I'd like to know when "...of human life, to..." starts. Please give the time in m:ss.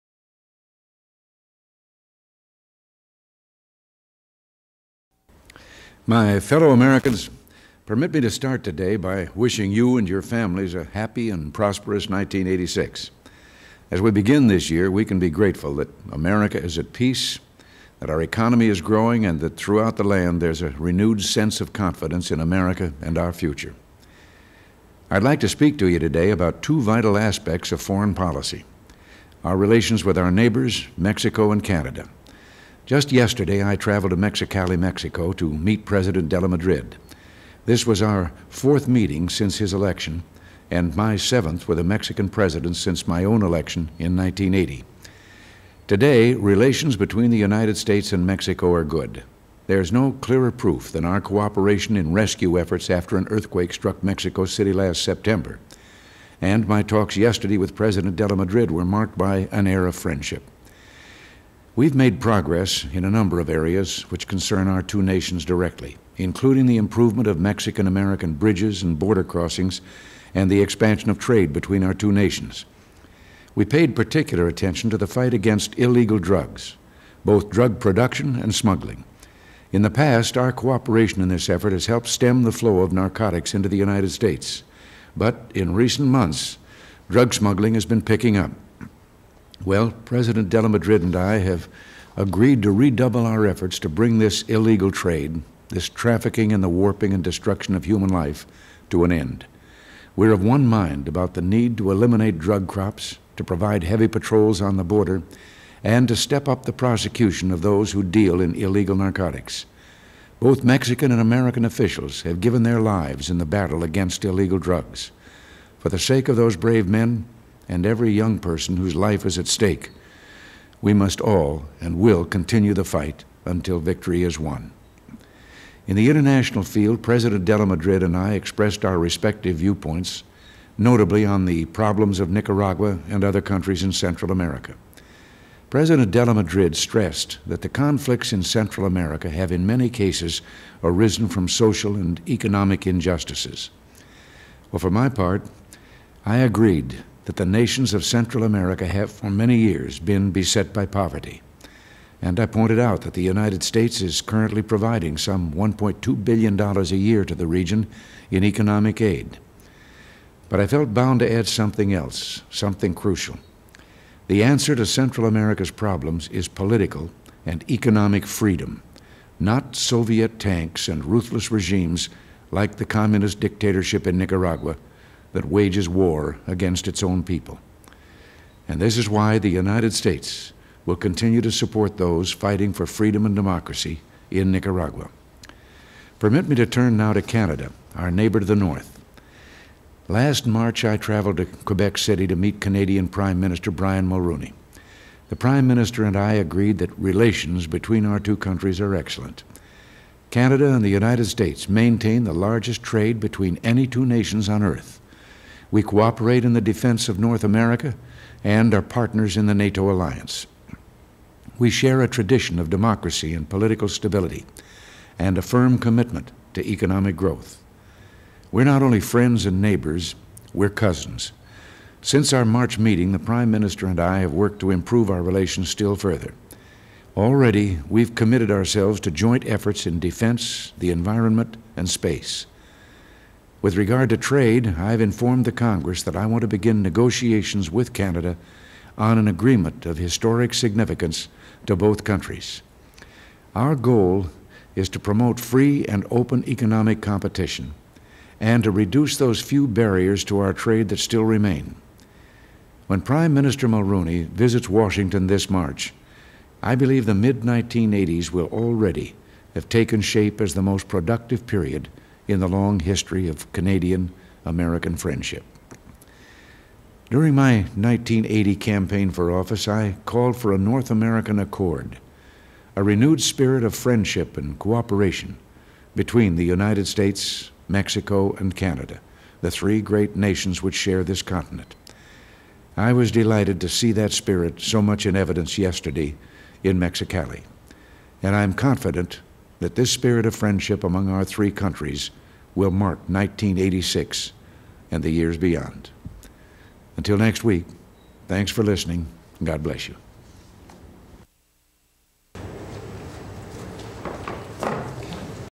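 1:37.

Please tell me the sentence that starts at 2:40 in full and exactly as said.
But I felt bound to add something else, something crucial.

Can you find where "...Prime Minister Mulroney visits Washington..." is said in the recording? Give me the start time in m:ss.
4:13.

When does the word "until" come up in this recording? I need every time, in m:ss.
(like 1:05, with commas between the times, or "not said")
2:03, 4:56.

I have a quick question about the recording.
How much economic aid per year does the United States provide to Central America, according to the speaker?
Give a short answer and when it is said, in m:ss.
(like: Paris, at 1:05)
$1.2 billion, at 2:35.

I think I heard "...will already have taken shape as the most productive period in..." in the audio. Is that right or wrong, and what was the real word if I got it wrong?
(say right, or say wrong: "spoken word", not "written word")
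right.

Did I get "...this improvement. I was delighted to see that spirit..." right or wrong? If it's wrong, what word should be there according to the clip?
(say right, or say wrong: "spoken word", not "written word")
wrong: "continent", not "improvement".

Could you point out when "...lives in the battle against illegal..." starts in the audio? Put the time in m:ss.
1:52.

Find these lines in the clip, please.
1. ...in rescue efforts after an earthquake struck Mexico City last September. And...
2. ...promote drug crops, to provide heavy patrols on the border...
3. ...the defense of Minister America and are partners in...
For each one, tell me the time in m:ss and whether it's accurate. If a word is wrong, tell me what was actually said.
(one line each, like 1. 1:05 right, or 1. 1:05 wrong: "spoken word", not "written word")
1. 0:51 right
2. 1:41 wrong: "eliminate", not "promote"
3. 3:26 wrong: "North", not "Minister".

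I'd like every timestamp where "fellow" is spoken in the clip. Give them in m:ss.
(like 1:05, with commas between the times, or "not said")
0:06.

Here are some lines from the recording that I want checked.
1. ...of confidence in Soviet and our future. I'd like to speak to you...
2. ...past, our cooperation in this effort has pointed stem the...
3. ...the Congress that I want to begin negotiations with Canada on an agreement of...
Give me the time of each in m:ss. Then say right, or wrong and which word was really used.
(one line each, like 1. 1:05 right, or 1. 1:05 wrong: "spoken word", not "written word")
1. 0:21 wrong: "America", not "Soviet"
2. 1:19 wrong: "helped", not "pointed"
3. 3:55 right.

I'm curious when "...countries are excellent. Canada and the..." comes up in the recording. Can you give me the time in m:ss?
3:18.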